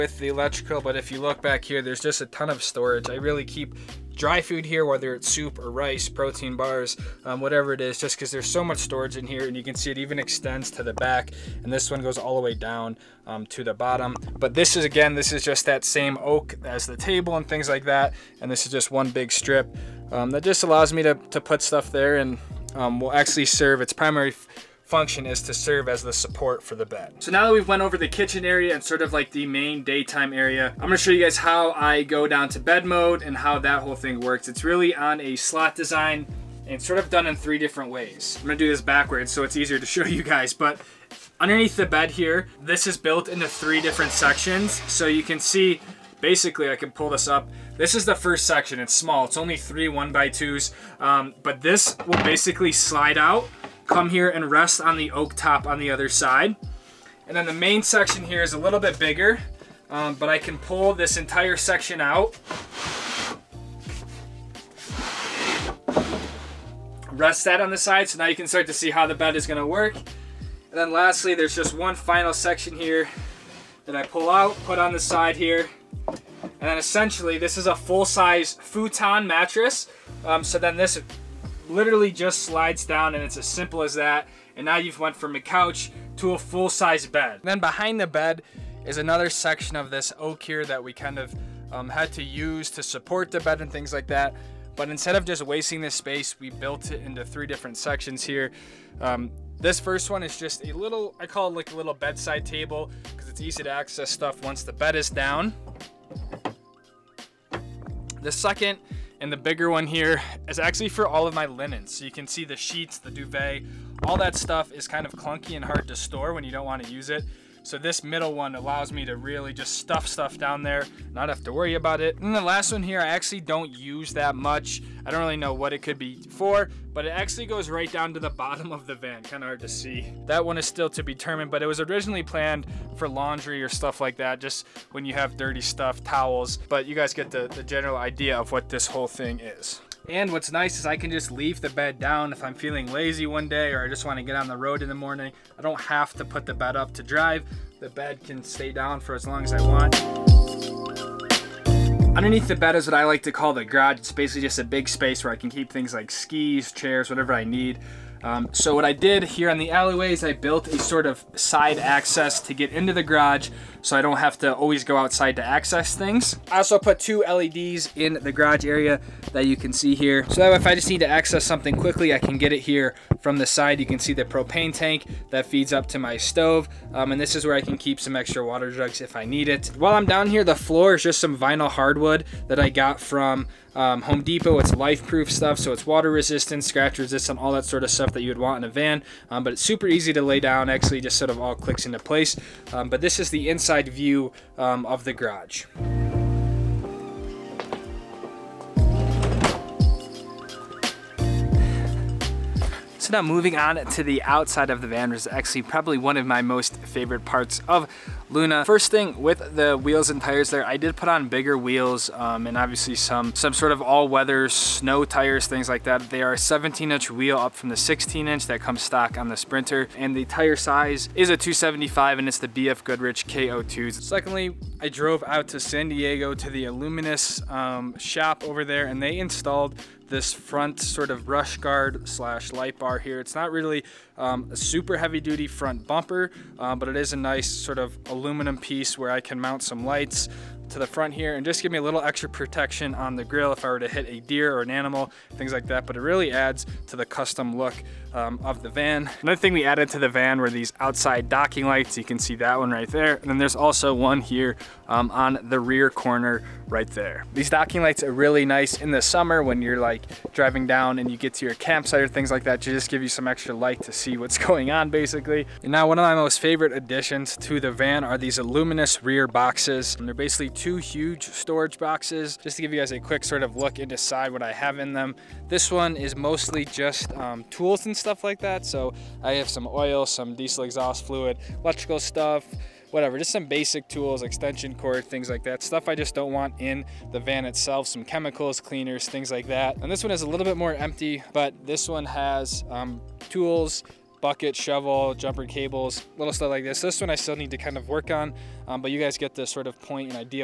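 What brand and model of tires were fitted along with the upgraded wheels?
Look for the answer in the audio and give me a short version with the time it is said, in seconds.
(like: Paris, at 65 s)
BF Goodrich KO2, at 222 s.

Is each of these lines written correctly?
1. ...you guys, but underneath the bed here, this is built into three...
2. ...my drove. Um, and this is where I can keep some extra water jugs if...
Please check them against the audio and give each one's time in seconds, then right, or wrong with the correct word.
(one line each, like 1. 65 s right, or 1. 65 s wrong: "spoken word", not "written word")
1. 40 s right
2. 175 s wrong: "stove", not "drove".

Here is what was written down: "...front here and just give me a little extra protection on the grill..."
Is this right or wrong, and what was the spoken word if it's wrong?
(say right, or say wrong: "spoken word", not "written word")
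right.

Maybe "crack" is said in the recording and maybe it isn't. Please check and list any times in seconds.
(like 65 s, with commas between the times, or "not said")
not said.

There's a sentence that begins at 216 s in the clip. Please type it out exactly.
They are 17-inch wheel up from the 16-inch that comes stock on the Sprinter.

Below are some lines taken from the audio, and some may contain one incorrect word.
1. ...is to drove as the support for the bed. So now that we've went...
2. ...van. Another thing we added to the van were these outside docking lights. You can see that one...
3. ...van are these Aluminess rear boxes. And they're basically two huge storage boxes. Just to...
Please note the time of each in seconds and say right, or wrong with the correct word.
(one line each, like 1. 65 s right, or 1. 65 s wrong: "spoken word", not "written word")
1. 25 s wrong: "serve", not "drove"
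2. 248 s right
3. 267 s right.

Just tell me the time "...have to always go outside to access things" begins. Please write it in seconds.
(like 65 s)
164 s.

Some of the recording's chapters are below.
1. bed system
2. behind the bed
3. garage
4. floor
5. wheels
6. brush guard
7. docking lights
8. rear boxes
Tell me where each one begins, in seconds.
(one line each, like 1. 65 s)
1. 26 s
2. 86 s
3. 150 s
4. 178 s
5. 194 s
6. 222 s
7. 247 s
8. 264 s.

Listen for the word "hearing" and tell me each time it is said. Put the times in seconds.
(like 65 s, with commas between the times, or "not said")
not said.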